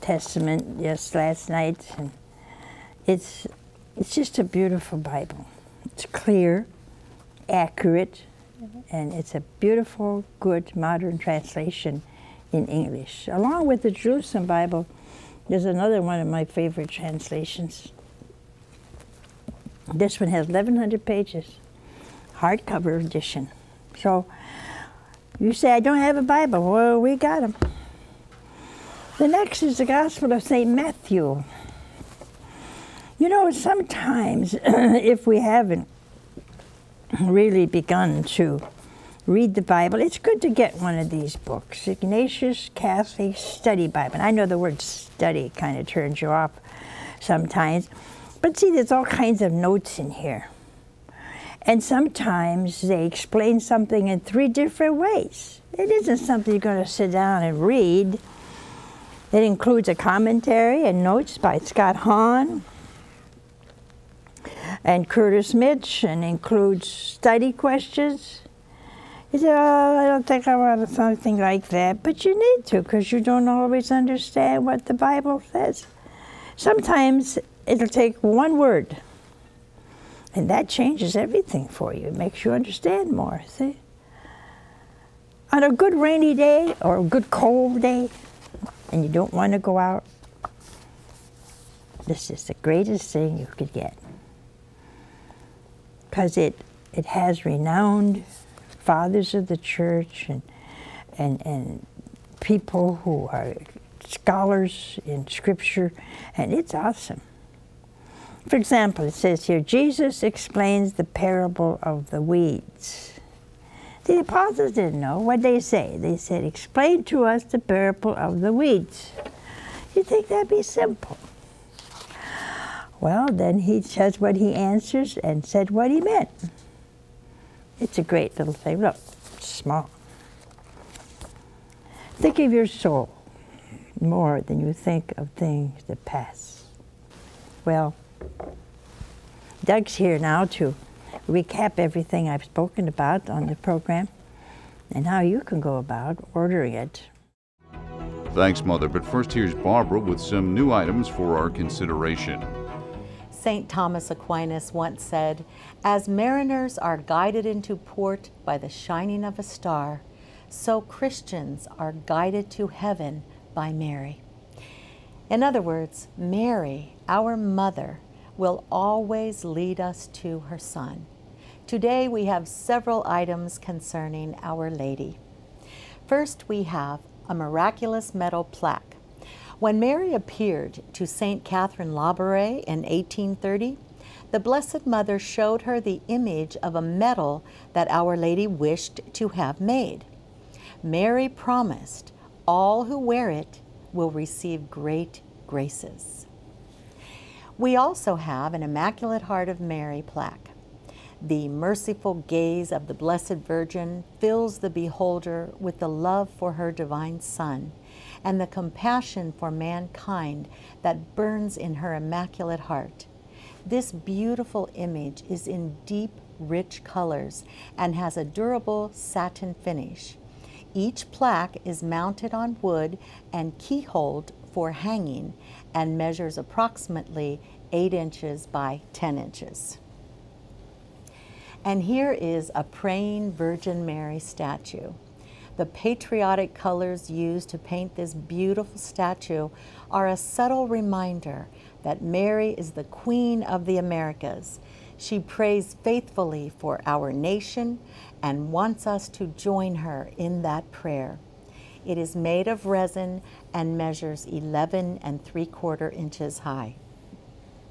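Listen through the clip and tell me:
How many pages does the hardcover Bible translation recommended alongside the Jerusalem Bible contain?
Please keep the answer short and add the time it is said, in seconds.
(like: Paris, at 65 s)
1,100, at 20 s.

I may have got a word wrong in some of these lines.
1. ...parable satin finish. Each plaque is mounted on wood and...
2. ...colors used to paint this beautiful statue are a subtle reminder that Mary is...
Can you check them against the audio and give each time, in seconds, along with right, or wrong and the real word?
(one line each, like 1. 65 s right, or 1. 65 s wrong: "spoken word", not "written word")
1. 218 s wrong: "durable", not "parable"
2. 236 s right.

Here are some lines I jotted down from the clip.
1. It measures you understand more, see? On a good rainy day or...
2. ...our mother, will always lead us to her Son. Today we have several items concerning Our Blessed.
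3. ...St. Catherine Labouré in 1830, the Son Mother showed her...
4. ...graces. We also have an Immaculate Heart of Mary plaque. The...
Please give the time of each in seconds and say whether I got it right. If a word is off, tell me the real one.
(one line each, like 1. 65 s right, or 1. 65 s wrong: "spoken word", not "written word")
1. 82 s wrong: "makes", not "measures"
2. 167 s wrong: "Lady", not "Blessed"
3. 181 s wrong: "Blessed", not "Son"
4. 195 s right.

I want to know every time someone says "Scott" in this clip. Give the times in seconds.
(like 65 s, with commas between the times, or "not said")
61 s.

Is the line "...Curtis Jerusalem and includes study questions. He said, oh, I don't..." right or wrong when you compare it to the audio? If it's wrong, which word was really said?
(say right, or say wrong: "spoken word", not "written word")
wrong: "Mitch", not "Jerusalem".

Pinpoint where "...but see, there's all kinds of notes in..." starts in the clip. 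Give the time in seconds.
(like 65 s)
48 s.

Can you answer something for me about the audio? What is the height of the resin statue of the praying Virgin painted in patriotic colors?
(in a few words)
11 3/4 inches.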